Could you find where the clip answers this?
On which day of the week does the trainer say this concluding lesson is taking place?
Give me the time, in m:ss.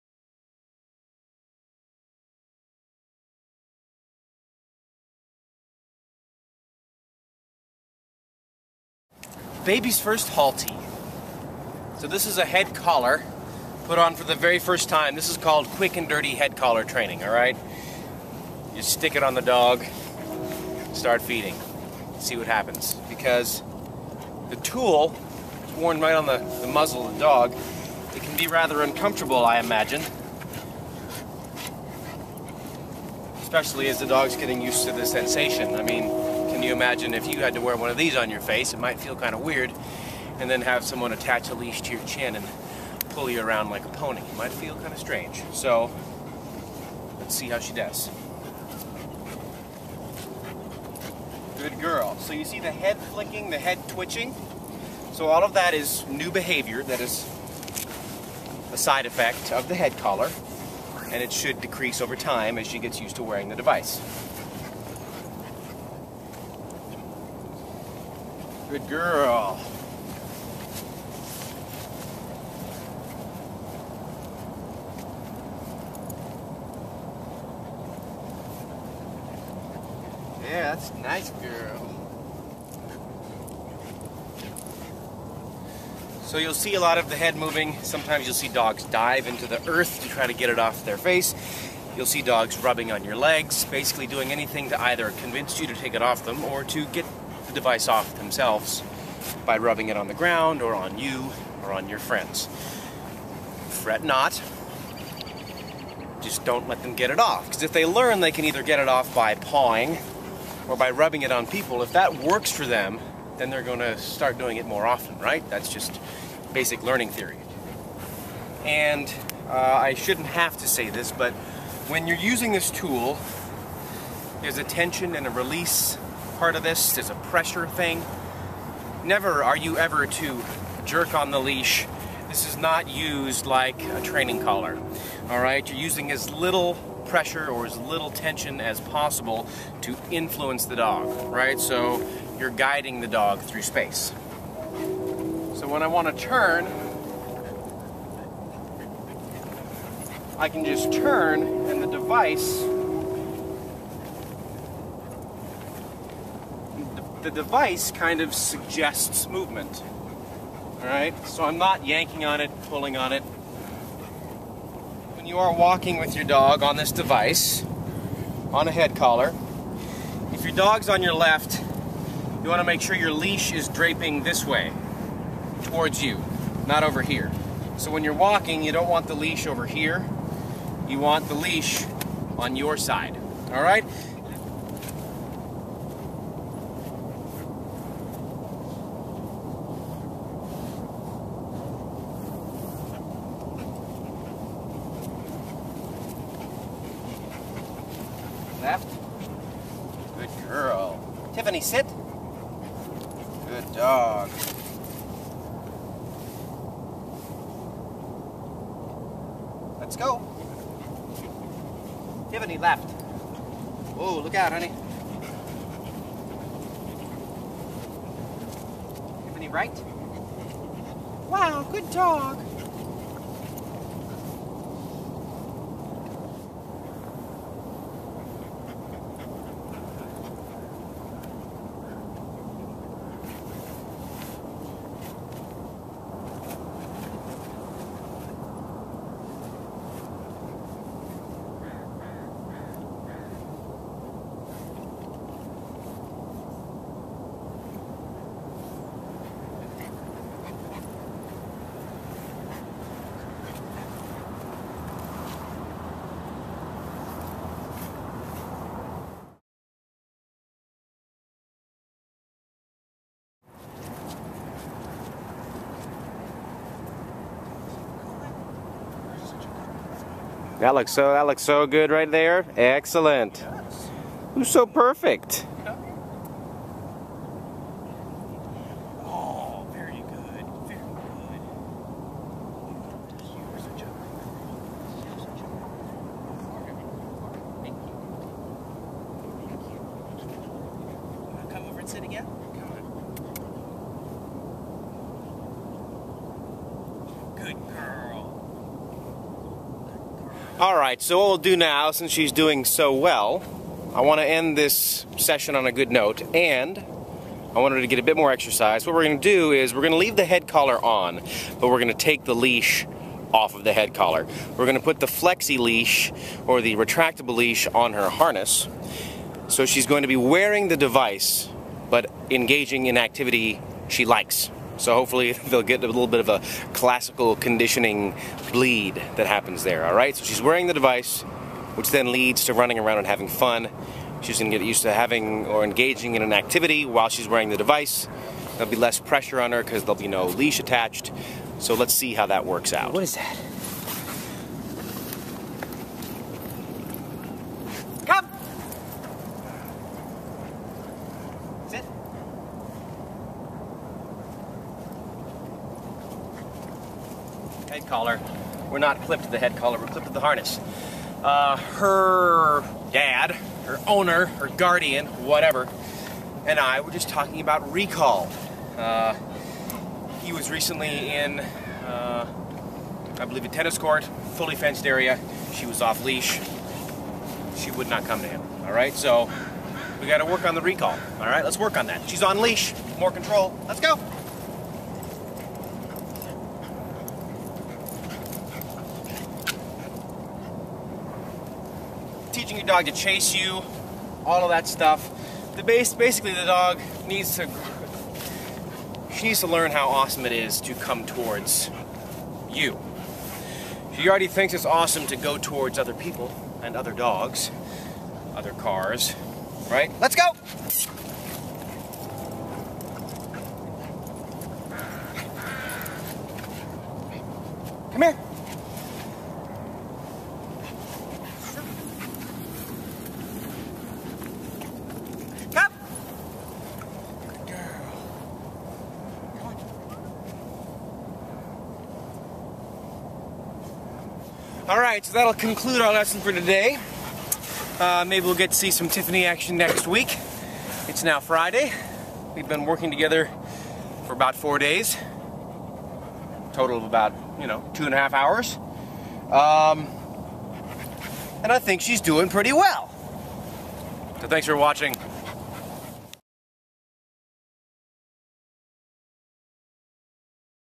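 7:21.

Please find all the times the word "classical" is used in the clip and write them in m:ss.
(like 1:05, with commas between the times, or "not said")
5:26.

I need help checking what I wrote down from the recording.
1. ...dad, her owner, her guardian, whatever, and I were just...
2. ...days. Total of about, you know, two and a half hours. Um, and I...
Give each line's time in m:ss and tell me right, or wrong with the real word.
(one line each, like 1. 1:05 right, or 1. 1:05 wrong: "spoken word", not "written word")
1. 6:02 right
2. 7:24 right.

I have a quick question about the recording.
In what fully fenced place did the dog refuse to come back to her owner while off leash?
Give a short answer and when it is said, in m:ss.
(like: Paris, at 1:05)
a tennis court, at 6:13.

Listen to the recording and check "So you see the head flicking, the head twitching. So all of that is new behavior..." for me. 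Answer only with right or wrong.
right.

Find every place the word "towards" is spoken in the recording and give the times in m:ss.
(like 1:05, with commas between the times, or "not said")
2:55, 6:41, 6:45.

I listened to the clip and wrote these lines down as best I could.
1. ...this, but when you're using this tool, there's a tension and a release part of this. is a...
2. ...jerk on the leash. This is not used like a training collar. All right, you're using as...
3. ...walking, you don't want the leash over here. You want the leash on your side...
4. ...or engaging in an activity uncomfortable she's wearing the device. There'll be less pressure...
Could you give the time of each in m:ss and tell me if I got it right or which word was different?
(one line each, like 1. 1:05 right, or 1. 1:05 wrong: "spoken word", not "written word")
1. 2:00 right
2. 2:10 right
3. 2:58 right
4. 5:35 wrong: "while", not "uncomfortable".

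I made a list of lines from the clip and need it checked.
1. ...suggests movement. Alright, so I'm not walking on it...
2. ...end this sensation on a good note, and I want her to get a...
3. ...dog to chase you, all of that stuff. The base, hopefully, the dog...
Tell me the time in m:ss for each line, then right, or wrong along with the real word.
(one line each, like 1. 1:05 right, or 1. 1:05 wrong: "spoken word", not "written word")
1. 2:38 wrong: "yanking", not "walking"
2. 5:04 wrong: "session", not "sensation"
3. 6:32 wrong: "basically", not "hopefully".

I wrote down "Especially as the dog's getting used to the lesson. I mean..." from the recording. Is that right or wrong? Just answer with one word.
wrong.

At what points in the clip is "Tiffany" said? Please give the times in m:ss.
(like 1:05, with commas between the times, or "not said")
3:32, 3:39, 7:18.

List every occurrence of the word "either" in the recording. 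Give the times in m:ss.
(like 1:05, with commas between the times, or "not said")
1:34, 1:48.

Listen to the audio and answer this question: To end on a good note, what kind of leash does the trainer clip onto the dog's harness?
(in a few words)
retractable leash.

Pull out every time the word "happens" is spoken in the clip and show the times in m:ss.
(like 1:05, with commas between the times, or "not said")
0:22, 5:29.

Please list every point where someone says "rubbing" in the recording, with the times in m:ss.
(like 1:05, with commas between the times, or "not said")
1:32, 1:39, 1:50.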